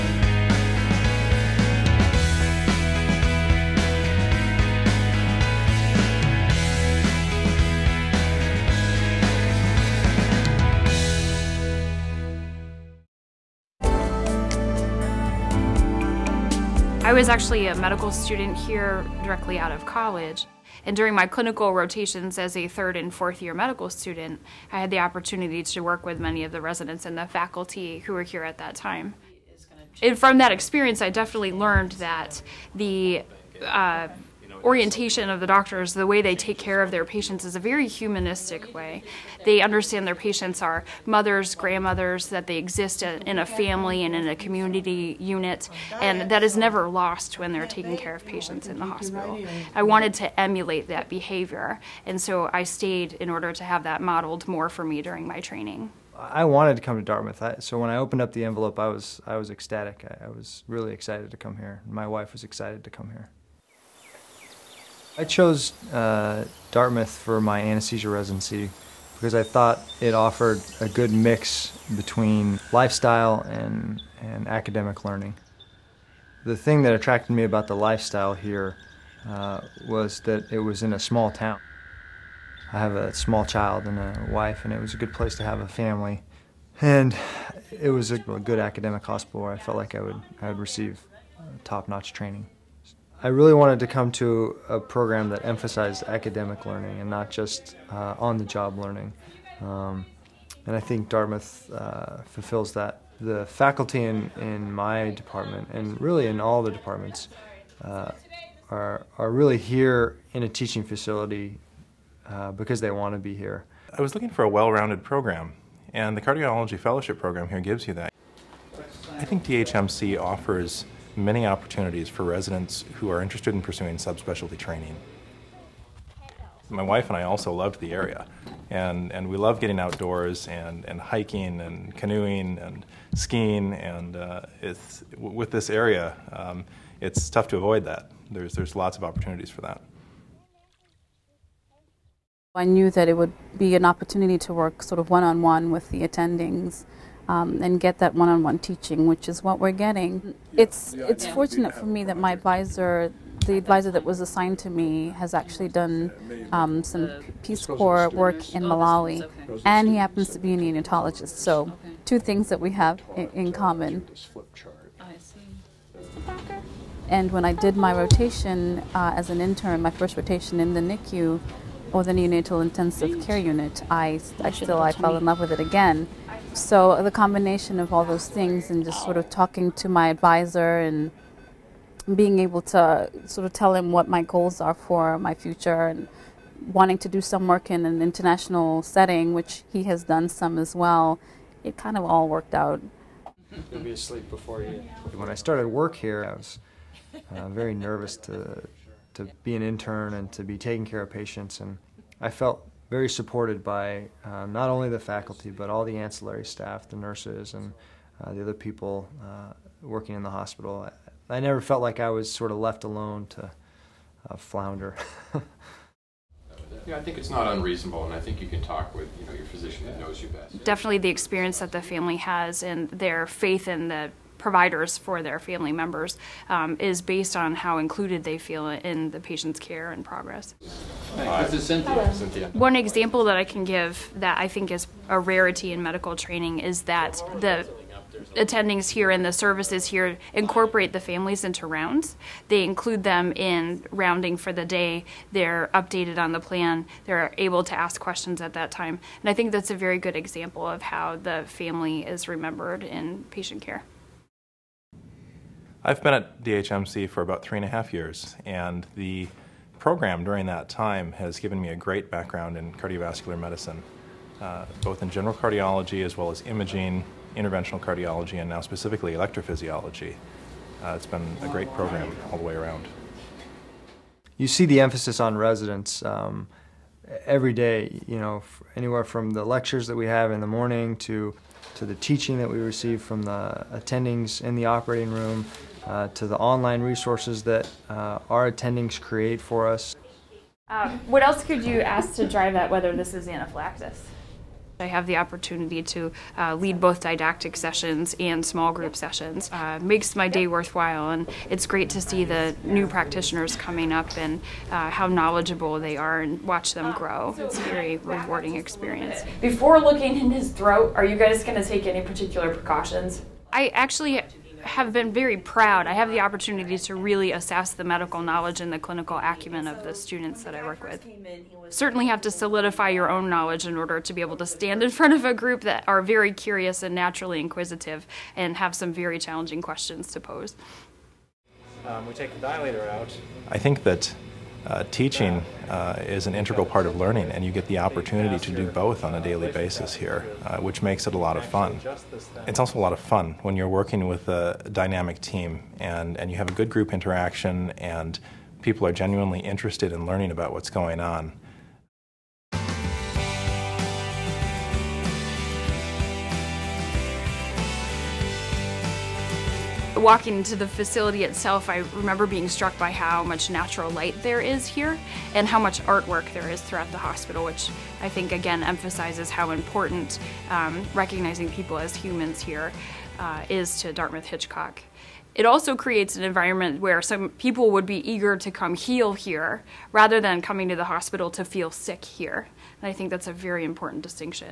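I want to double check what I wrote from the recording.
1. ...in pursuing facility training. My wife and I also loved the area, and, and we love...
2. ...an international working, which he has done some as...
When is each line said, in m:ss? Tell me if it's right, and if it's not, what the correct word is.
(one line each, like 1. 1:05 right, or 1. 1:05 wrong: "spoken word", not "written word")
1. 2:03 wrong: "subspecialty", not "facility"
2. 3:07 wrong: "setting", not "working".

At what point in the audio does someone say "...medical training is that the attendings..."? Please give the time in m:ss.
3:55.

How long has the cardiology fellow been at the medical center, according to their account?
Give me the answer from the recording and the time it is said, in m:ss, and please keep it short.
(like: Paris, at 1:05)
3.5 years, at 4:17.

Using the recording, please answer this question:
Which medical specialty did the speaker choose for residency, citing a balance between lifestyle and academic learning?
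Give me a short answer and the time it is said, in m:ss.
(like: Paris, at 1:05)
Anesthesia, at 1:07.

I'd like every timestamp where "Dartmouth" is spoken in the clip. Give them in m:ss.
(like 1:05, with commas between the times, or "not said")
0:57, 1:06, 1:41, 6:13.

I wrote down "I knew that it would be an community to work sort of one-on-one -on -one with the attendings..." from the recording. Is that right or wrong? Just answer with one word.
wrong.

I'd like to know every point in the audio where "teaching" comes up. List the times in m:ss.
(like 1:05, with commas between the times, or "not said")
1:50, 2:28, 4:41, 5:34.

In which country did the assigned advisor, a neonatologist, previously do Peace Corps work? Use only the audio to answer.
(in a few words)
Malawi.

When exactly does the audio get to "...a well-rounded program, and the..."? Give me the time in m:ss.
1:54.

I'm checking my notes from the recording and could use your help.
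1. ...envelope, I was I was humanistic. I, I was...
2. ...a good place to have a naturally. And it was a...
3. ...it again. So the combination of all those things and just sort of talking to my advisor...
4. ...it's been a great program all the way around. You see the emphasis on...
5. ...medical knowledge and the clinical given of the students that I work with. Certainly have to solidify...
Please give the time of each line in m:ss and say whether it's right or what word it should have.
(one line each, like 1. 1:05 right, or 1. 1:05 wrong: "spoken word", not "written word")
1. 0:58 wrong: "ecstatic", not "humanistic"
2. 1:24 wrong: "family", not "naturally"
3. 2:55 right
4. 4:30 right
5. 5:17 wrong: "acumen", not "given".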